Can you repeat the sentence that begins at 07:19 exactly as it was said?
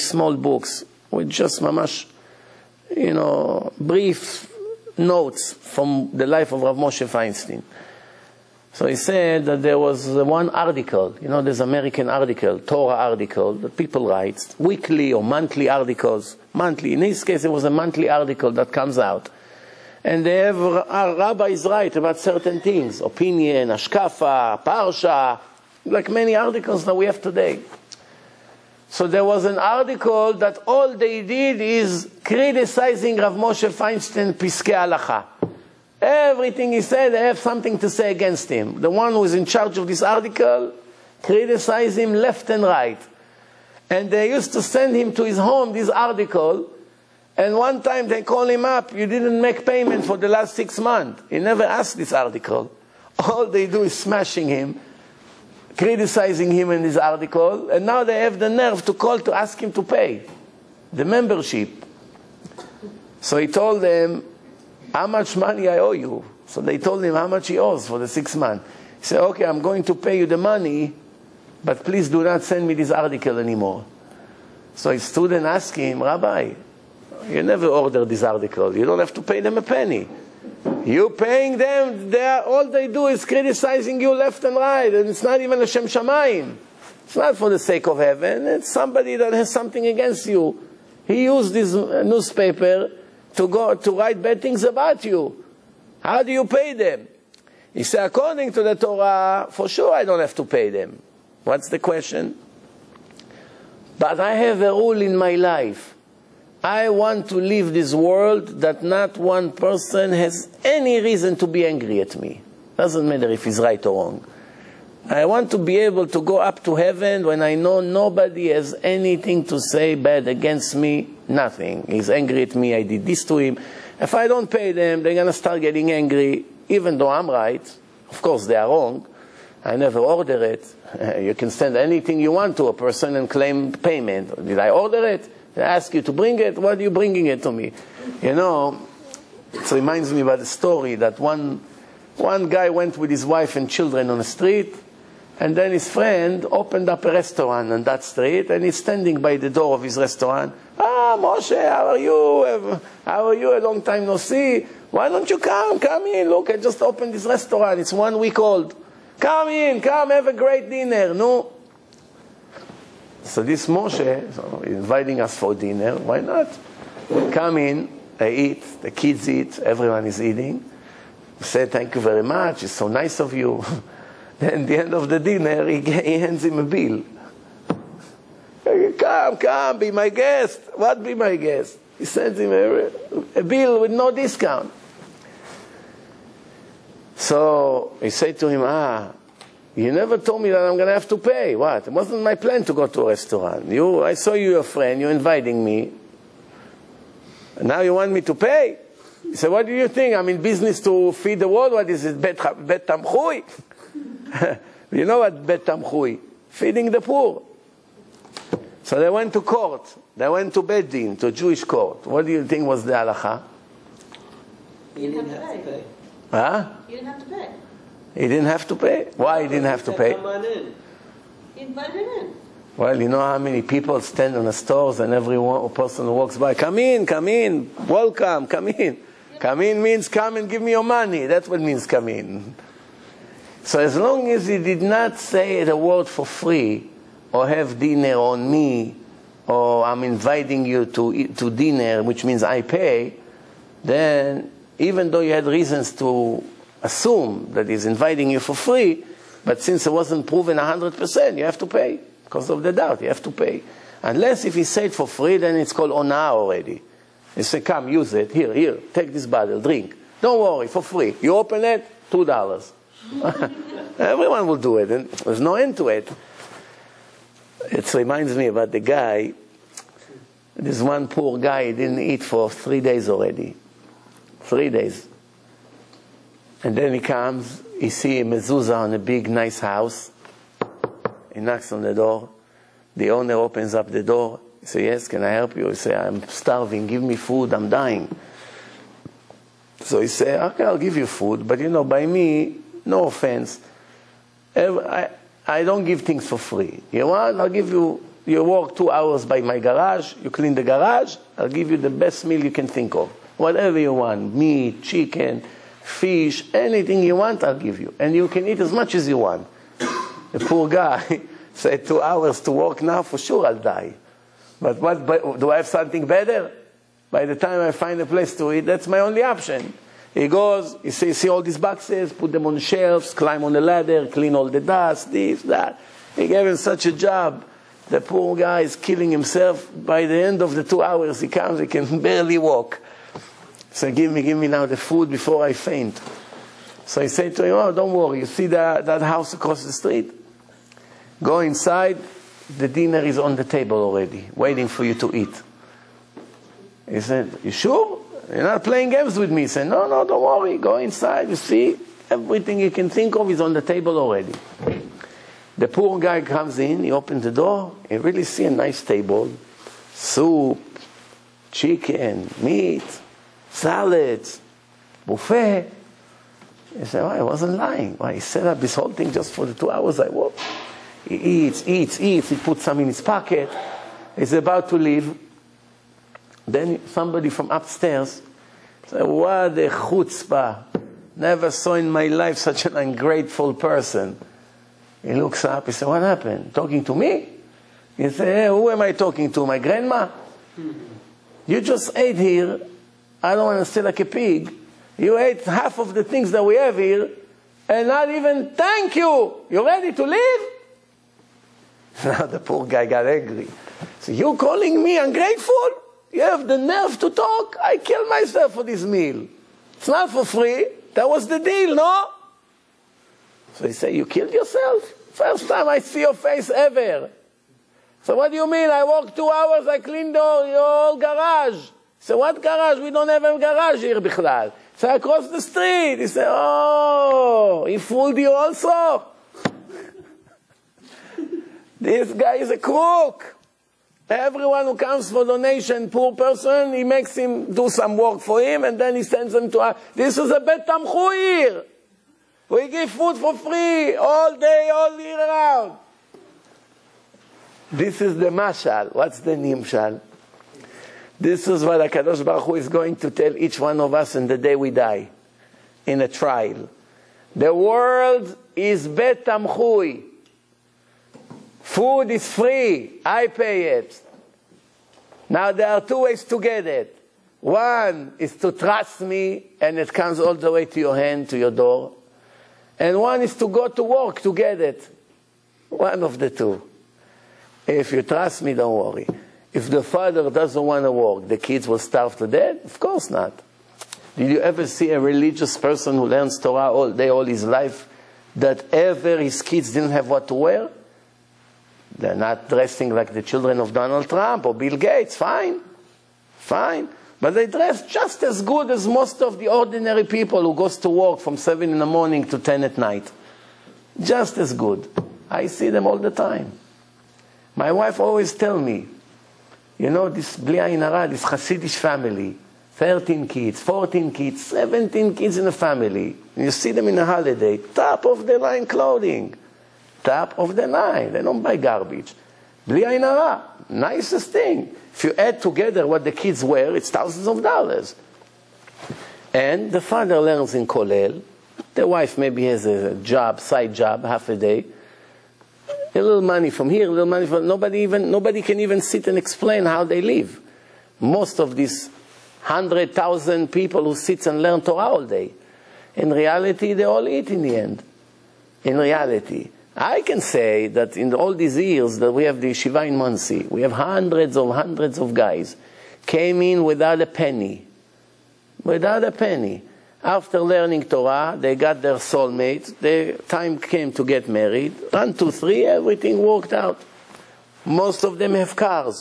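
This is a bet tamchui We give food for free all day, all year round.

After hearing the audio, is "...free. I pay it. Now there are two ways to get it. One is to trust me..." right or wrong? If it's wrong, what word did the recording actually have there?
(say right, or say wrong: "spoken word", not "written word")
right.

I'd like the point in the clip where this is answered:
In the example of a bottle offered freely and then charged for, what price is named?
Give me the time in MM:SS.
04:22.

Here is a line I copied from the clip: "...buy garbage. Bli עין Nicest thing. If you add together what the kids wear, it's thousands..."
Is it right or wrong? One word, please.
right.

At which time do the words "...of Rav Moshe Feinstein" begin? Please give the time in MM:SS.
00:06.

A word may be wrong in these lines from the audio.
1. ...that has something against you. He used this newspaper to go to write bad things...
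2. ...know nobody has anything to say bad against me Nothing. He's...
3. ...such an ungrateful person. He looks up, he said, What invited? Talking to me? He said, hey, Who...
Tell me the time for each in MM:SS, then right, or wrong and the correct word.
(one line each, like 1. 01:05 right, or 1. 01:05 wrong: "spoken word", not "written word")
1. 01:29 right
2. 01:57 right
3. 06:22 wrong: "happened", not "invited".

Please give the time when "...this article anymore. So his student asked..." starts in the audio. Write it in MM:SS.
01:12.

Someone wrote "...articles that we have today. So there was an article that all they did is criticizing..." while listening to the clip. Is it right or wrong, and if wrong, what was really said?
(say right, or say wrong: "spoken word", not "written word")
right.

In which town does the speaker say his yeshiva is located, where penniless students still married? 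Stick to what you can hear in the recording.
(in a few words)
Monsey.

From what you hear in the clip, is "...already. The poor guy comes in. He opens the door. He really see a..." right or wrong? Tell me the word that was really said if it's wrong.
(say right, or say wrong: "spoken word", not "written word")
right.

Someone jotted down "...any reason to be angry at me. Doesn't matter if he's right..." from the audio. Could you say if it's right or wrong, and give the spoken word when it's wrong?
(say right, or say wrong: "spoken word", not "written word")
right.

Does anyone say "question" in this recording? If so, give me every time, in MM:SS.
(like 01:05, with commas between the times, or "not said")
01:41.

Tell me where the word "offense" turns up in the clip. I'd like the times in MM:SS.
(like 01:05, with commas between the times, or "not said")
04:53.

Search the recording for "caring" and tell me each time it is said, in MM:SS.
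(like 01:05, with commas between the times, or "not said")
not said.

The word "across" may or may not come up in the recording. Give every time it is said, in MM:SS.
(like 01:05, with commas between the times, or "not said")
05:39, 07:04.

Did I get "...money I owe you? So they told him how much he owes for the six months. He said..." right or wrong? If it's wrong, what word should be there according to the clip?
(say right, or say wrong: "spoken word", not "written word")
right.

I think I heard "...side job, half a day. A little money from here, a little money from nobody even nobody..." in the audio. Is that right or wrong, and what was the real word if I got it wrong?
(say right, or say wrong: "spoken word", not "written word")
right.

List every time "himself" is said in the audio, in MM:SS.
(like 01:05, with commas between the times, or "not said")
05:29.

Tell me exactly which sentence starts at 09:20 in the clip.
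After learning Torah, they got their soulmate.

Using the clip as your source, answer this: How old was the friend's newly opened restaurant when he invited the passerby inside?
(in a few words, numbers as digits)
1 week.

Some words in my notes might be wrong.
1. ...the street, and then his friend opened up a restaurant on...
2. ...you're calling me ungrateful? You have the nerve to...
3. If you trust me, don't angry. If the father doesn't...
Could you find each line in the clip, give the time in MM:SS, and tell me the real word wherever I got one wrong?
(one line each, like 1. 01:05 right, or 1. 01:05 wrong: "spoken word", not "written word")
1. 02:24 right
2. 06:44 right
3. 07:57 wrong: "worry", not "angry".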